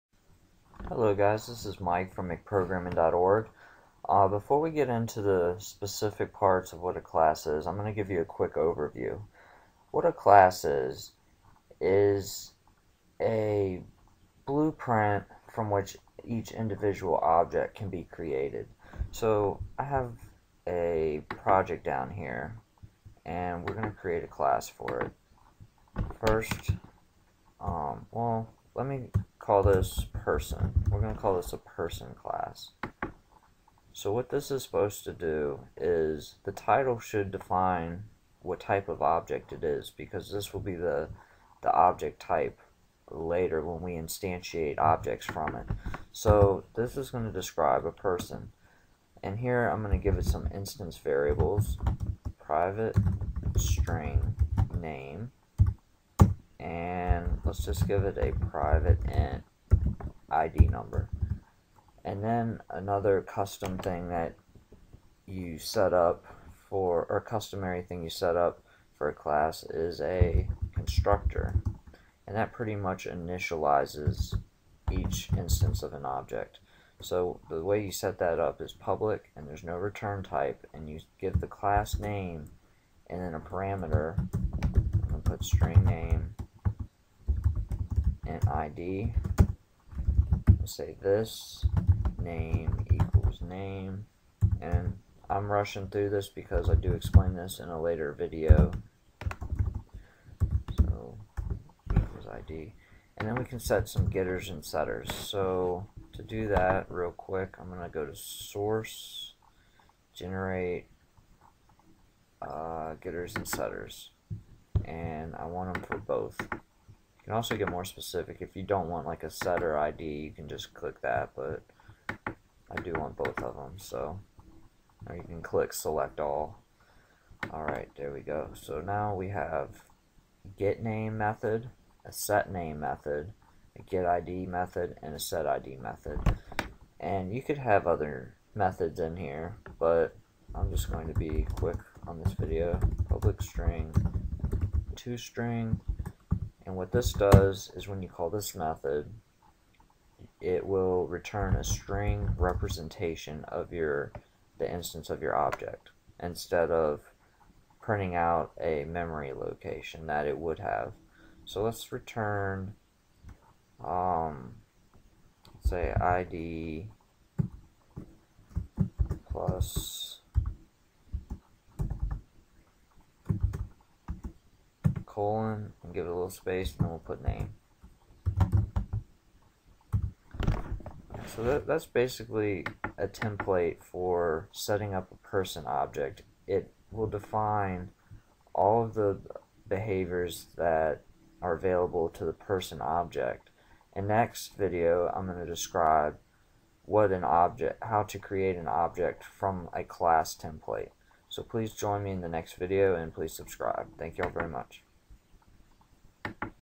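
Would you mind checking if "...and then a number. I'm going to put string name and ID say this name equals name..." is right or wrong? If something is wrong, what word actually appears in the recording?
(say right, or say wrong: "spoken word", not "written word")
wrong: "parameter", not "number".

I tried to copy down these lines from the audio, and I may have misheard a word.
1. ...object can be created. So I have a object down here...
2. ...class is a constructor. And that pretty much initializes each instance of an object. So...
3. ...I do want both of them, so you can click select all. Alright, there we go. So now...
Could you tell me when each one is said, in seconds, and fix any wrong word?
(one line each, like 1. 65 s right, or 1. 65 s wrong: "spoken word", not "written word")
1. 17 s wrong: "project", not "object"
2. 69 s right
3. 122 s right.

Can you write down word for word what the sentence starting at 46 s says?
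So this is going to describe a person.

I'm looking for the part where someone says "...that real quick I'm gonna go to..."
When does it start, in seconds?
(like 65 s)
106 s.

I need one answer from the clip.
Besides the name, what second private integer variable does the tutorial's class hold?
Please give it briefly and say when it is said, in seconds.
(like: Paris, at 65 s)
ID number, at 60 s.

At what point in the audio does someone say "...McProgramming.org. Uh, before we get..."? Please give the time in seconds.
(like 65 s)
2 s.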